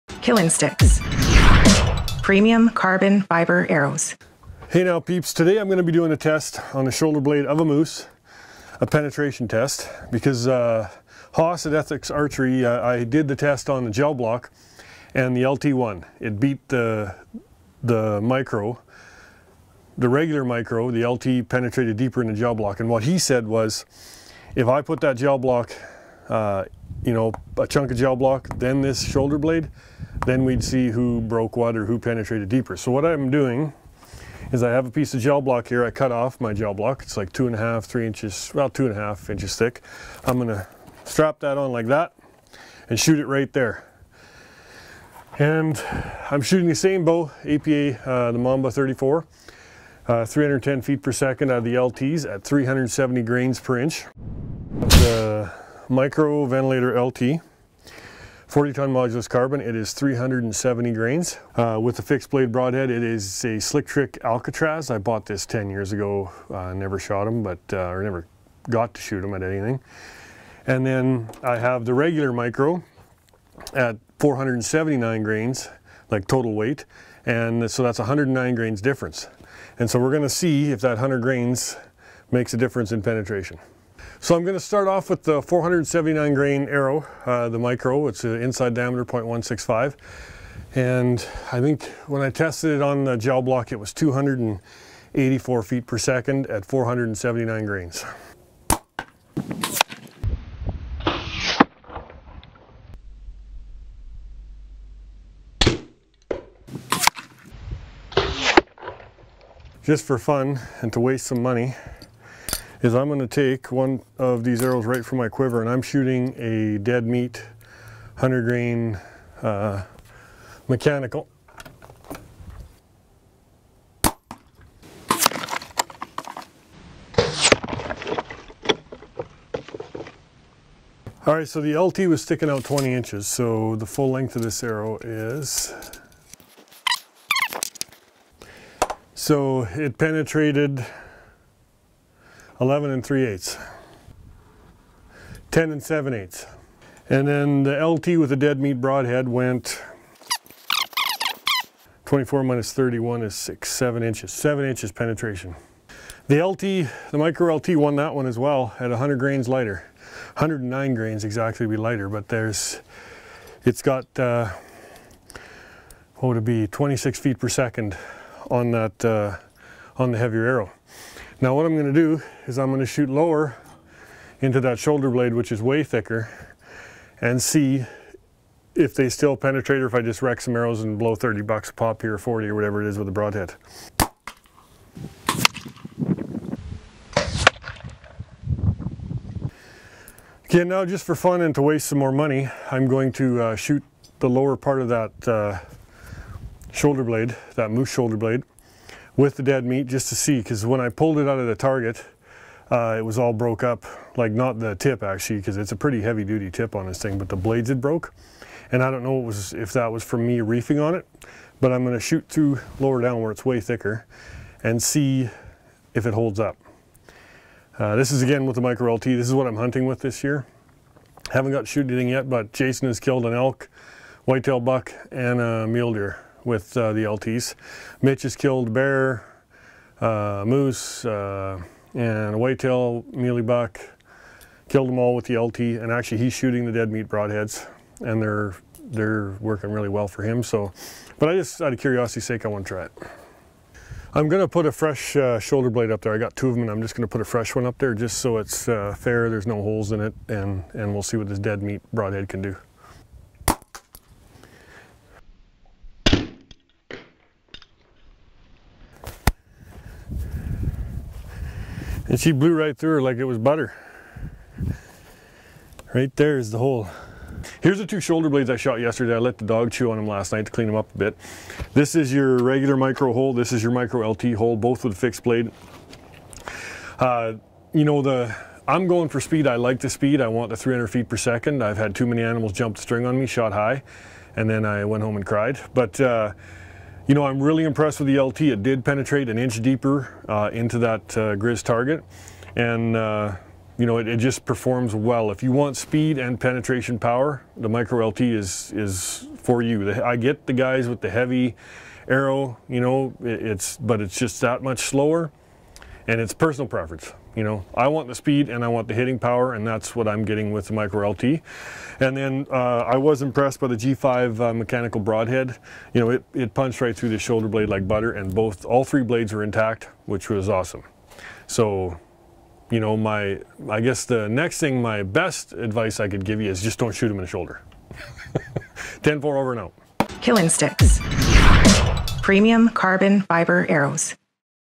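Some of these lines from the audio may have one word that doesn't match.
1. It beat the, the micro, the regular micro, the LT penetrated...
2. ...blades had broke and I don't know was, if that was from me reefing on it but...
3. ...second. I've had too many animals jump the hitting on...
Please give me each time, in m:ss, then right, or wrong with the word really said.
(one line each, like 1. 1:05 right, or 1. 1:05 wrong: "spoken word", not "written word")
1. 0:16 right
2. 3:27 right
3. 4:41 wrong: "string", not "hitting".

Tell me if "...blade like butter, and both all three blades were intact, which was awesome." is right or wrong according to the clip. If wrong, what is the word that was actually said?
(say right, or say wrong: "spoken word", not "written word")
right.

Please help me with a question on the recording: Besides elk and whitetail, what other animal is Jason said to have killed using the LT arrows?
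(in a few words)
mule deer.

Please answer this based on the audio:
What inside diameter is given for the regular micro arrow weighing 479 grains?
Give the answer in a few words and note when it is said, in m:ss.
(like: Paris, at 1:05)
0.165, at 1:29.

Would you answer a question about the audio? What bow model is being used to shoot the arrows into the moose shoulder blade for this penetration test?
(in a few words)
Mamba 34.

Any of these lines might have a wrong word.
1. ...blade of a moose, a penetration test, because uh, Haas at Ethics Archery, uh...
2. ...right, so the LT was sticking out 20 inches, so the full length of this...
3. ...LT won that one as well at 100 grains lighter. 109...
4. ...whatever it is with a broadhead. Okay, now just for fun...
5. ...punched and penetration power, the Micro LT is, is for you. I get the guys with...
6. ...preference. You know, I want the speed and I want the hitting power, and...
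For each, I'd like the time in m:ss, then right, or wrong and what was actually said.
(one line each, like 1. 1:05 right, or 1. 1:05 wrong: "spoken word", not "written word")
1. 0:07 right
2. 2:11 right
3. 2:37 right
4. 3:02 right
5. 4:55 wrong: "speed", not "punched"
6. 5:06 right.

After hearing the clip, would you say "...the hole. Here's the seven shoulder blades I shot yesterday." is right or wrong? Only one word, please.
wrong.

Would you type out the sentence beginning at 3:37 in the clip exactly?
Uh, this is again with the micro LT.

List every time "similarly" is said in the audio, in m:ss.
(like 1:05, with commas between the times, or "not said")
not said.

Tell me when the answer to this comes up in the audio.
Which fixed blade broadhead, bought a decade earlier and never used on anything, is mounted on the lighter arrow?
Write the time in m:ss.
1:03.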